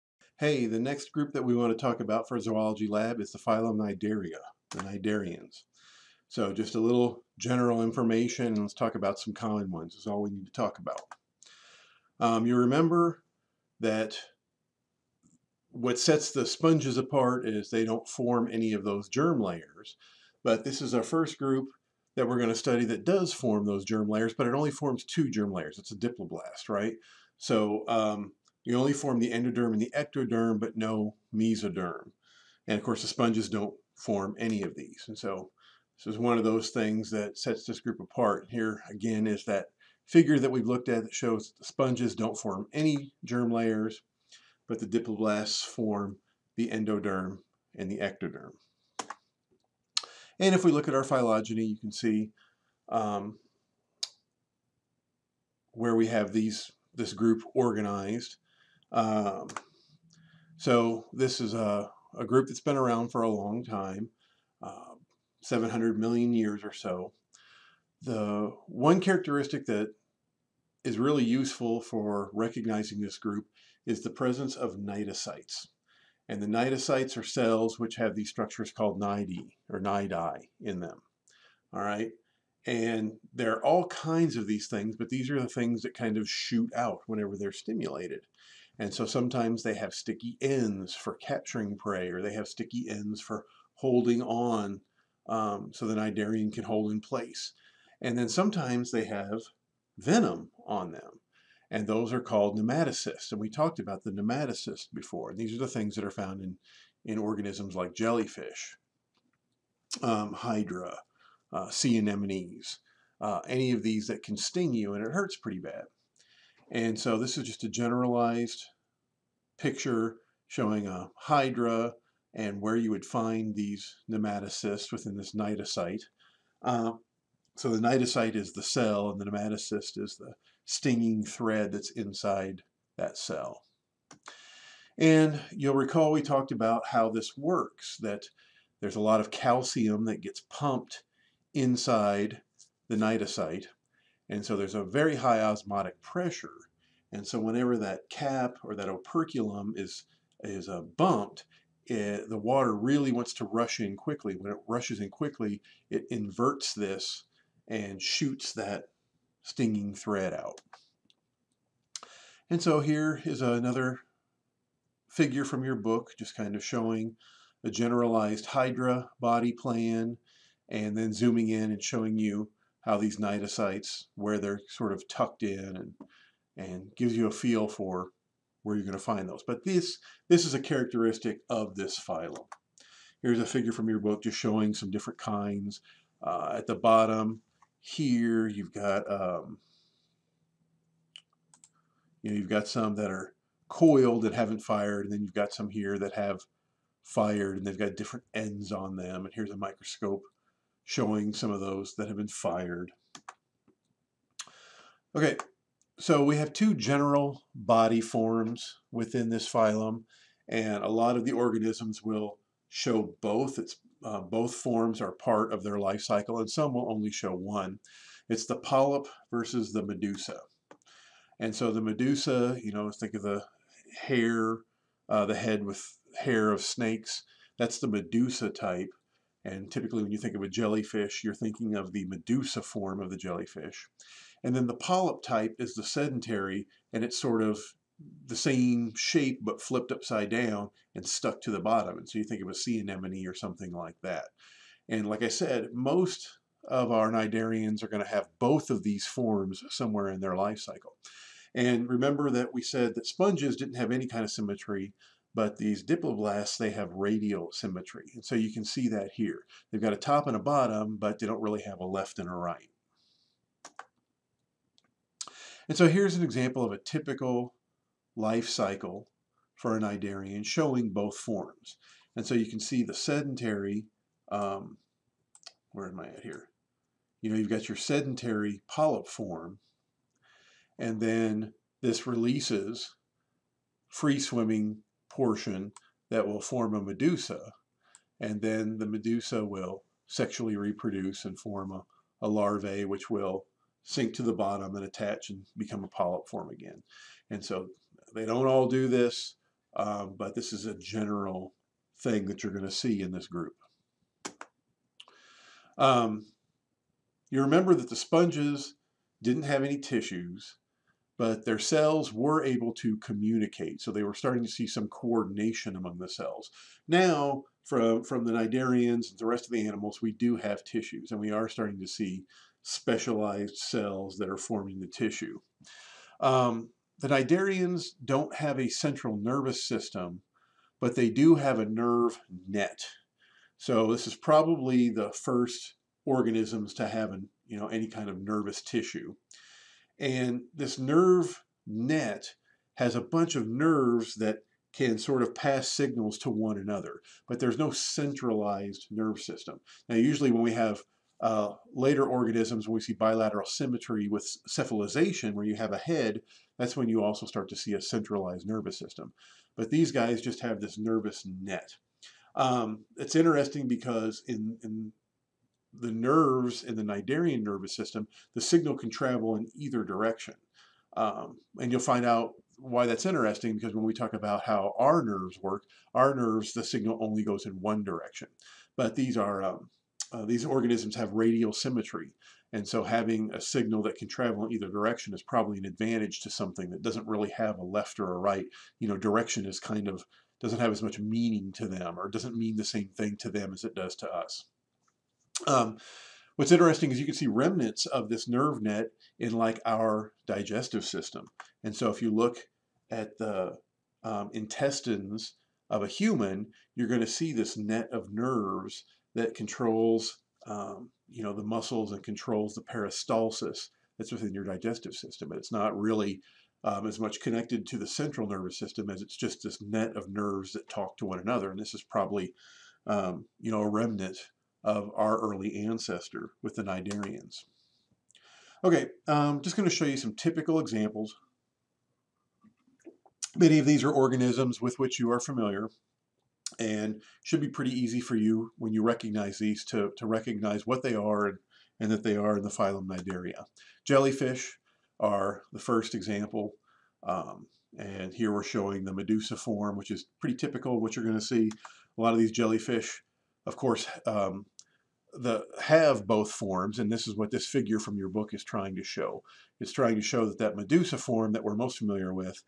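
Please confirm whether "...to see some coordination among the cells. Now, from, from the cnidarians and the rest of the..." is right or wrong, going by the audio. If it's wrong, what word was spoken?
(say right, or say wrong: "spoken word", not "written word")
right.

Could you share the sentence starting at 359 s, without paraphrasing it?
But these guys just have this nervous net.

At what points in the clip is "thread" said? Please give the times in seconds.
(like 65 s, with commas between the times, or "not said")
131 s, 159 s.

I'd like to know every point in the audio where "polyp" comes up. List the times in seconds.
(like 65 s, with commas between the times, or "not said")
218 s, 234 s, 278 s, 295 s.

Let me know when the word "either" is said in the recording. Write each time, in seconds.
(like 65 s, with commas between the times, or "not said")
369 s, 384 s.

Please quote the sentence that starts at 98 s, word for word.
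And then sometimes they have venom on them.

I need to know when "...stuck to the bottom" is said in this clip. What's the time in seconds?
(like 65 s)
241 s.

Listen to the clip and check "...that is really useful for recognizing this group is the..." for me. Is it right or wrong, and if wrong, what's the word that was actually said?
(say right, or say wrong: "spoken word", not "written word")
right.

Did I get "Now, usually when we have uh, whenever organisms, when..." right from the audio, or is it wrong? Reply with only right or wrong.
wrong.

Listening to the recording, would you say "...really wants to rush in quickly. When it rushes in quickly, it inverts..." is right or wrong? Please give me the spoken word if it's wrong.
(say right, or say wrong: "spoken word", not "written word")
right.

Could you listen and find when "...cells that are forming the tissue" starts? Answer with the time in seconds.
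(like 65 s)
323 s.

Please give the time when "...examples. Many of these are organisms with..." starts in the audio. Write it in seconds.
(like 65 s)
430 s.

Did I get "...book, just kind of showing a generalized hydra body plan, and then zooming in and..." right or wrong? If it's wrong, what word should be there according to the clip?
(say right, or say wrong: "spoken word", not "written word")
right.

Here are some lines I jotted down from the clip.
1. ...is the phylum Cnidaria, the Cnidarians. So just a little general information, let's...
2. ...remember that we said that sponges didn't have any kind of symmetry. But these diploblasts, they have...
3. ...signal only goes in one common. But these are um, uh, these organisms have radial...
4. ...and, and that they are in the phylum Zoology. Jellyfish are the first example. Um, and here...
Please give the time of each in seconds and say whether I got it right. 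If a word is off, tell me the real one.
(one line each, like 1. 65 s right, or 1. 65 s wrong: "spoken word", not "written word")
1. 3 s right
2. 251 s right
3. 376 s wrong: "direction", not "common"
4. 441 s wrong: "Cnidaria", not "Zoology".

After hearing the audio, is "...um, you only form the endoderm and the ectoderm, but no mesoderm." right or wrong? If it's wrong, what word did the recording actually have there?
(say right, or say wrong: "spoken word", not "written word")
right.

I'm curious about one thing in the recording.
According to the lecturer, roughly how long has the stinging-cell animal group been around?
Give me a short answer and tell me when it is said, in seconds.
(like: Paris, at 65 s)
700 million years, at 65 s.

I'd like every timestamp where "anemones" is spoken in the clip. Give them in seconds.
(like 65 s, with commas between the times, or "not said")
111 s, 242 s.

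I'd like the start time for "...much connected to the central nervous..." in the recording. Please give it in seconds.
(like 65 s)
417 s.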